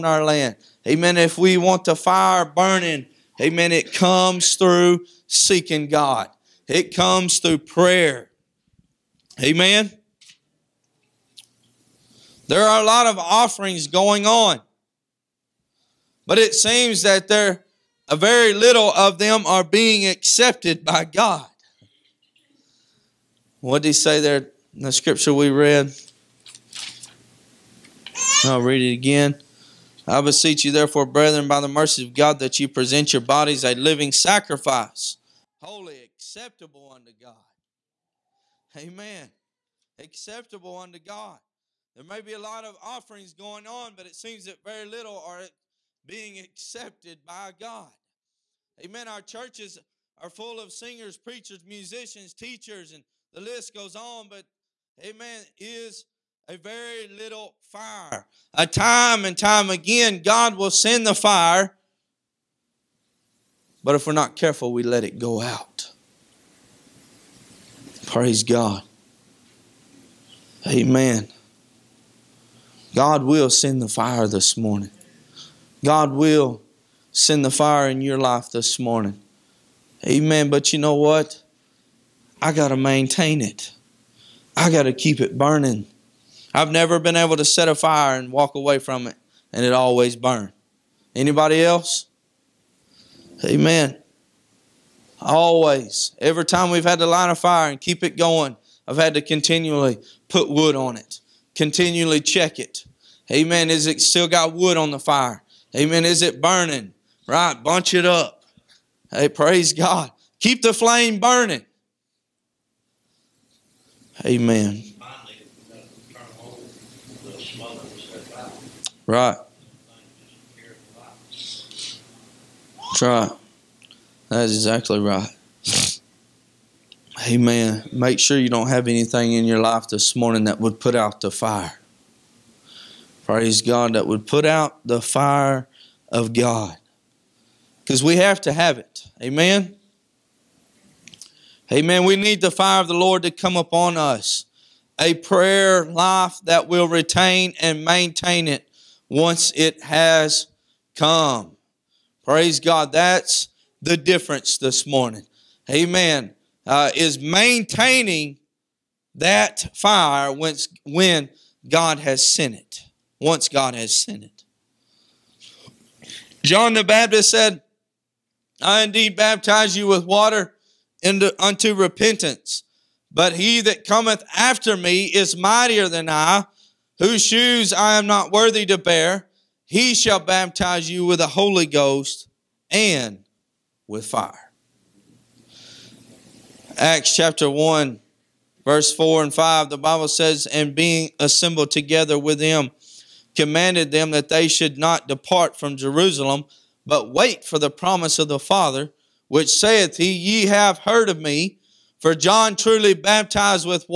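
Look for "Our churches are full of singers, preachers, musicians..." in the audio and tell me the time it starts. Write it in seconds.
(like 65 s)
49 s.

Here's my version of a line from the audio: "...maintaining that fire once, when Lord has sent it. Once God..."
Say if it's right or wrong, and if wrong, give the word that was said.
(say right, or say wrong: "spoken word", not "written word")
wrong: "God", not "Lord".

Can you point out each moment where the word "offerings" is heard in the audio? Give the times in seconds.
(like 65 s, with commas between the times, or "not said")
13 s, 42 s.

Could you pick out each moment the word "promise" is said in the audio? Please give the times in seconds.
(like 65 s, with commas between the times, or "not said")
197 s.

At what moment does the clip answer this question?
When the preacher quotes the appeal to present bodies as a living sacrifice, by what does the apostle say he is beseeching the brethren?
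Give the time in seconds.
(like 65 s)
31 s.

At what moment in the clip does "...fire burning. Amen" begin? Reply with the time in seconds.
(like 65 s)
1 s.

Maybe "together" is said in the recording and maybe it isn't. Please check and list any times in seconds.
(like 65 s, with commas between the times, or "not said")
191 s.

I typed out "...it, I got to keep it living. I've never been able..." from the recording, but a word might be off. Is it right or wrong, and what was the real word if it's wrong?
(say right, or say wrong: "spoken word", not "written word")
wrong: "burning", not "living".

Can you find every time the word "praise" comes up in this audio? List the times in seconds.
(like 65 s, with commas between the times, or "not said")
68 s, 109 s, 133 s, 152 s.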